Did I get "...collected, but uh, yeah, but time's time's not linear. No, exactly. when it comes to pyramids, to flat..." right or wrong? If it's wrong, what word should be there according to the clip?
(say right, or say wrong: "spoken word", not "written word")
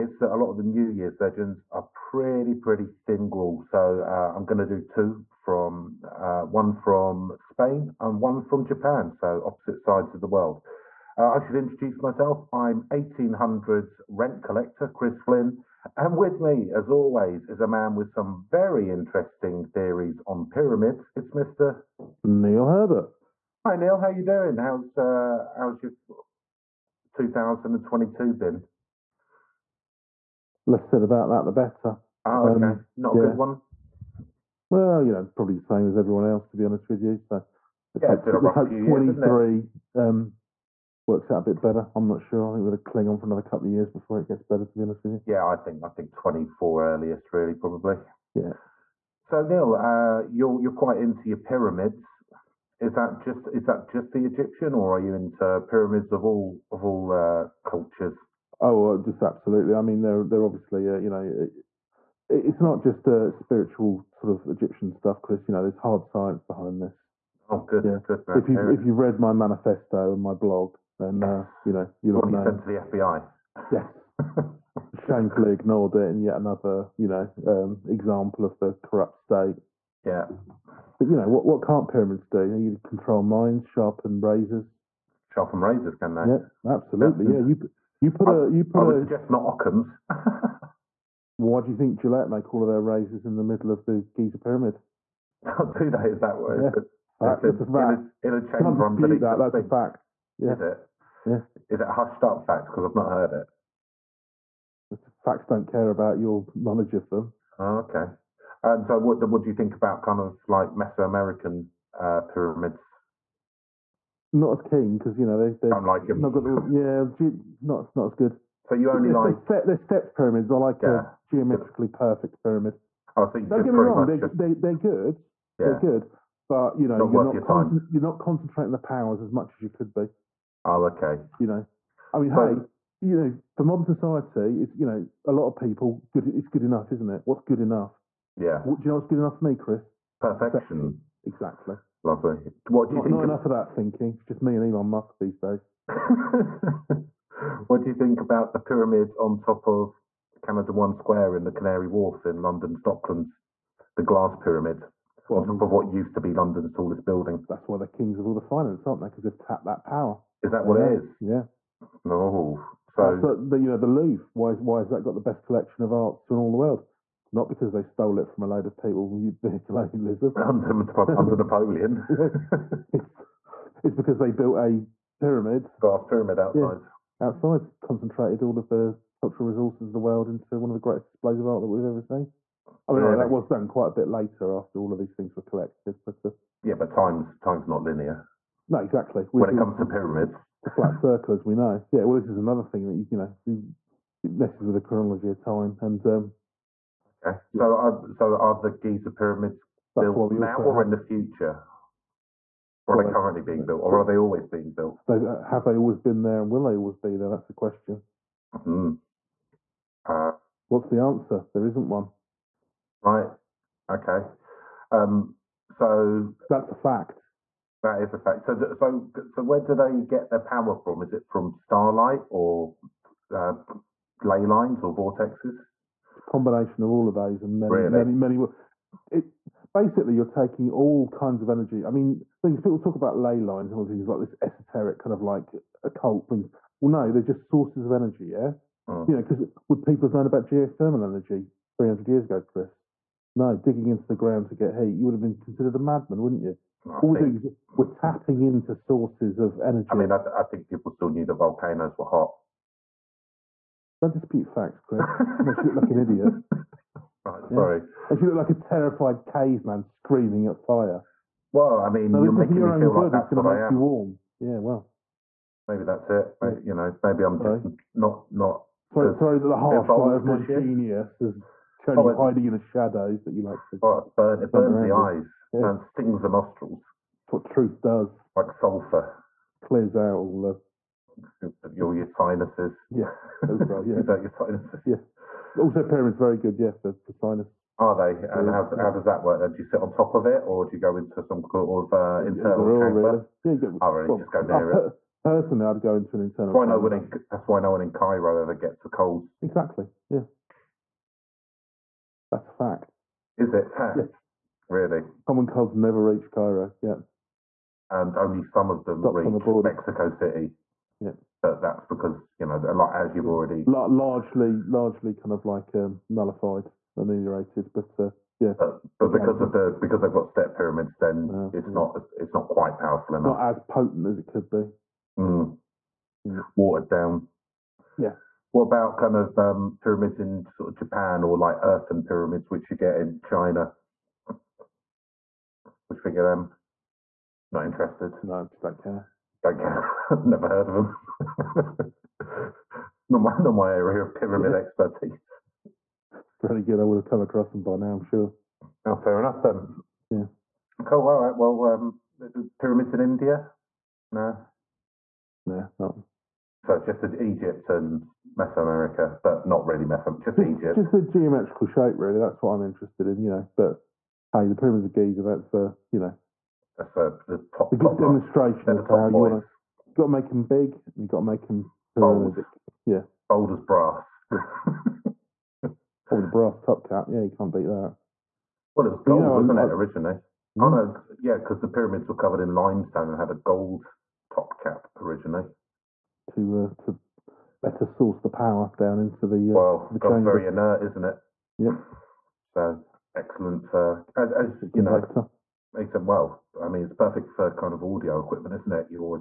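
right.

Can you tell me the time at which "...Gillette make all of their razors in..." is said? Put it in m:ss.
1:31.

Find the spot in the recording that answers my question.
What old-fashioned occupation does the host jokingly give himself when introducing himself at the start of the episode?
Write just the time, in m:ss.
0:12.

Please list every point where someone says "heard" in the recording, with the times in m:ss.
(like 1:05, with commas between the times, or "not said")
1:43, 5:40.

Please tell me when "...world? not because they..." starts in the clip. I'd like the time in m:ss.
2:46.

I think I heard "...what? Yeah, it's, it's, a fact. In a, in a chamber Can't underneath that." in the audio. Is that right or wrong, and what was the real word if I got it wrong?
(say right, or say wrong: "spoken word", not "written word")
right.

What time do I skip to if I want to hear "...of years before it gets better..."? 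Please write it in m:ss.
0:43.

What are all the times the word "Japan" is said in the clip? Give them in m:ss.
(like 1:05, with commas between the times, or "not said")
0:08, 5:30.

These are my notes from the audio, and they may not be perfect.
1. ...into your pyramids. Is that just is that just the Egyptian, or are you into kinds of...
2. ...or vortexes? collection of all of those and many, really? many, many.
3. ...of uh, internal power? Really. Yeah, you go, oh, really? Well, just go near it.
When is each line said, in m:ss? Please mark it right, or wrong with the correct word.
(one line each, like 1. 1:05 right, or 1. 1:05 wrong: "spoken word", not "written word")
1. 0:50 wrong: "pyramids", not "kinds"
2. 3:44 wrong: "combination", not "collection"
3. 4:51 wrong: "chamber", not "power".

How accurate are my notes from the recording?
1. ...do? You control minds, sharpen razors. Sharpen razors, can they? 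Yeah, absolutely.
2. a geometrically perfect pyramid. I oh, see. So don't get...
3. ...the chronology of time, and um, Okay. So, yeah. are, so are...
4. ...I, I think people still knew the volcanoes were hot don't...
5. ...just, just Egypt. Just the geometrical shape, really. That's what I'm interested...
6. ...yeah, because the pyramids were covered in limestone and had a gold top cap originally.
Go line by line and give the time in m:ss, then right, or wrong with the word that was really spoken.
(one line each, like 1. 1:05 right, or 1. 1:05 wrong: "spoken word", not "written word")
1. 1:22 right
2. 2:01 right
3. 3:14 right
4. 4:10 right
5. 6:00 right
6. 6:21 right.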